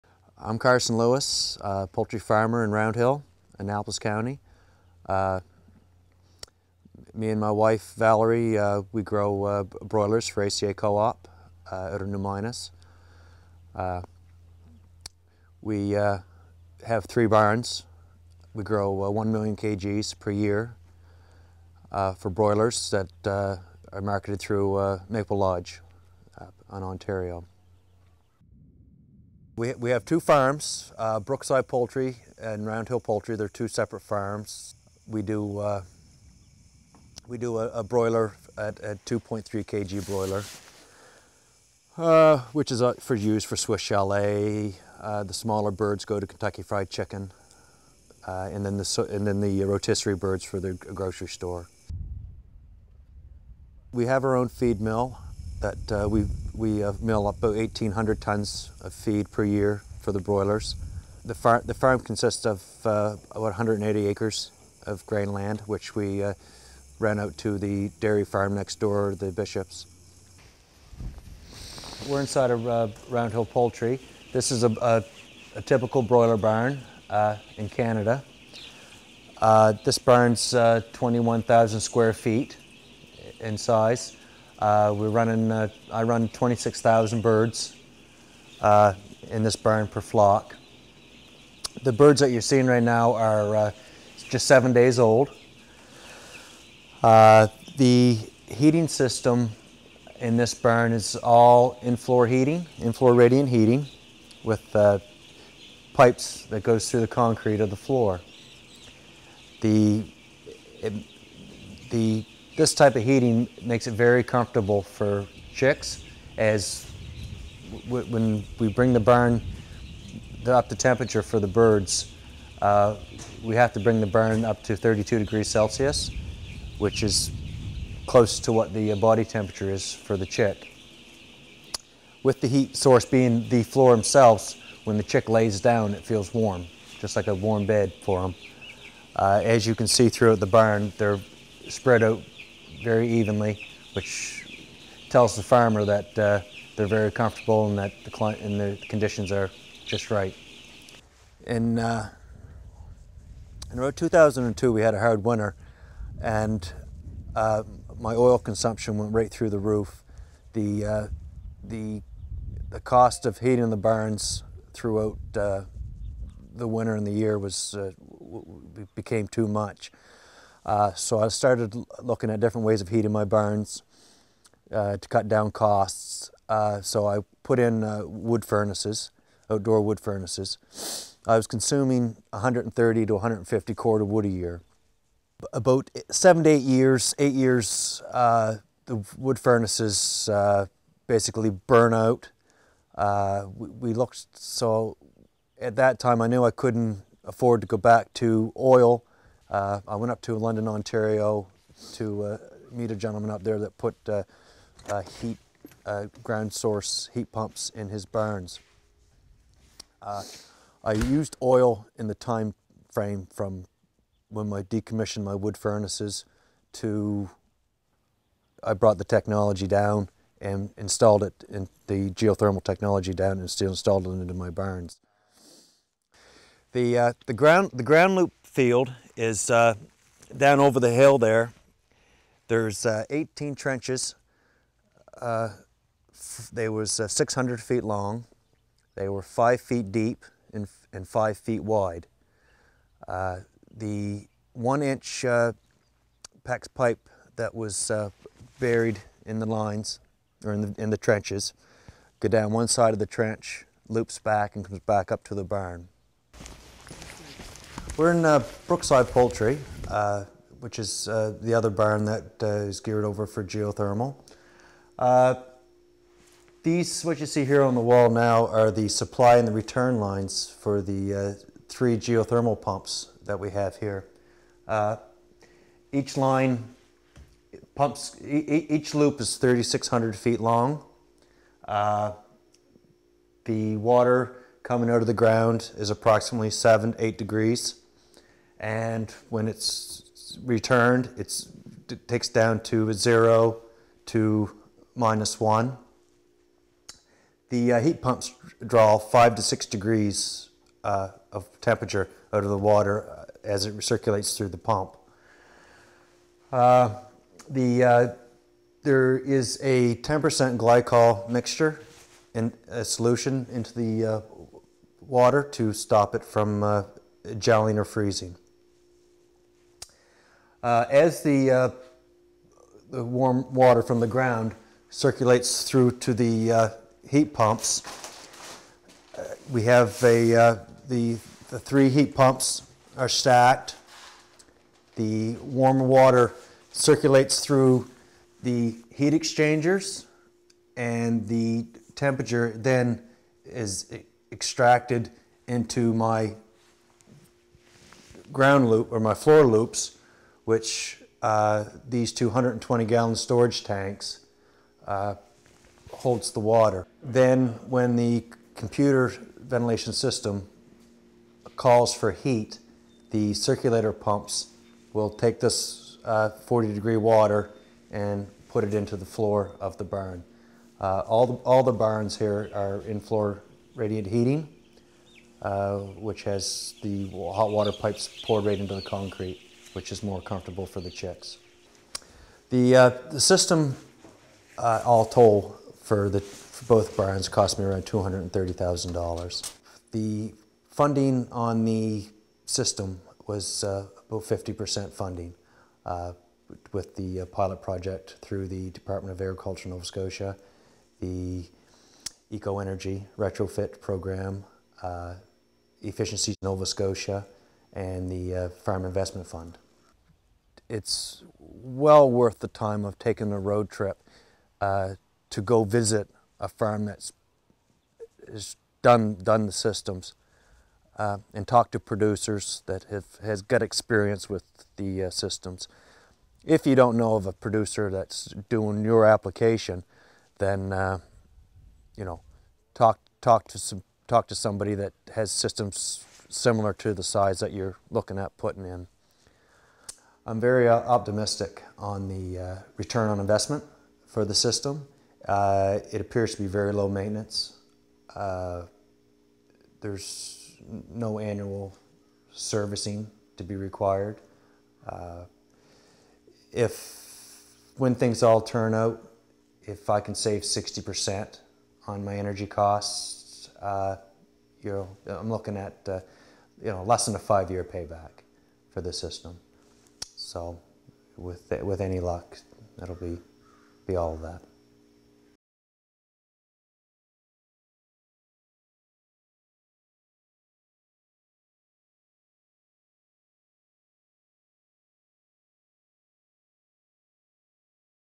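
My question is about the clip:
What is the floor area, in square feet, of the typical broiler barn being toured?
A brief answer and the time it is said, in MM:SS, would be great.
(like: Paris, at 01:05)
21,000 square feet, at 01:20.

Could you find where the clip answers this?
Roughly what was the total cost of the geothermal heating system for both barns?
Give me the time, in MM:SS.
06:27.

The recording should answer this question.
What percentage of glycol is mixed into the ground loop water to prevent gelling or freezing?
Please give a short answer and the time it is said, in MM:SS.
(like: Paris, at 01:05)
10%, at 05:09.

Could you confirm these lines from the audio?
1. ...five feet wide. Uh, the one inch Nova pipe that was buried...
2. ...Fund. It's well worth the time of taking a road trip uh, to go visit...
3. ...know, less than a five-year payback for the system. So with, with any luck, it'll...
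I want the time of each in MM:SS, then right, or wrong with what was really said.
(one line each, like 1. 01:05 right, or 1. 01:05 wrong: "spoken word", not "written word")
1. 04:01 wrong: "PEX", not "Nova"
2. 06:49 right
3. 07:46 right.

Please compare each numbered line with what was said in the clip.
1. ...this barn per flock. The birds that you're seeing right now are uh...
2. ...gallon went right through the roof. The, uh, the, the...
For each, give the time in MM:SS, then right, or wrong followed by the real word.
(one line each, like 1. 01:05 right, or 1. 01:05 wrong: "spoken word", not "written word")
1. 01:29 right
2. 02:38 wrong: "consumption", not "gallon".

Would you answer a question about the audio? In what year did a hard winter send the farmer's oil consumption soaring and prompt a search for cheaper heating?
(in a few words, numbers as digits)
2002.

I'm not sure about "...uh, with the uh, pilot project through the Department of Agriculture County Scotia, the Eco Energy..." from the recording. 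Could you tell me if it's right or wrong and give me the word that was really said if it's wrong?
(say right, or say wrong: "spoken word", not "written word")
wrong: "Nova", not "County".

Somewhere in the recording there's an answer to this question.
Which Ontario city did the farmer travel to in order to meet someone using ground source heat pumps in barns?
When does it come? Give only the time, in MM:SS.
03:20.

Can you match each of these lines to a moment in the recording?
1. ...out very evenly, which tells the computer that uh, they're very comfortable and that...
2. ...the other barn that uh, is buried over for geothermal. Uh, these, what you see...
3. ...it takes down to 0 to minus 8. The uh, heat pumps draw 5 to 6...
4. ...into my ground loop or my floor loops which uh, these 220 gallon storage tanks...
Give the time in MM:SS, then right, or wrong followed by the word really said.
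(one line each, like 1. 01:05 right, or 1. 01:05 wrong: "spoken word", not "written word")
1. 02:22 wrong: "farmer", not "computer"
2. 04:21 wrong: "geared", not "buried"
3. 04:51 wrong: "1", not "8"
4. 05:45 right.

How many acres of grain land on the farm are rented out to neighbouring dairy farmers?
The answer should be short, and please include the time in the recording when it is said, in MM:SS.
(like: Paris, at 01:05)
180 acres, at 01:03.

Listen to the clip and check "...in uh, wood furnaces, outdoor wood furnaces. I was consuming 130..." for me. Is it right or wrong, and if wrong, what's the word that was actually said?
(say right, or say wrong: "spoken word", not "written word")
right.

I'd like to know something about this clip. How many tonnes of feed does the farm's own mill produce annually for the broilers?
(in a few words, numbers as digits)
1,800 tonnes.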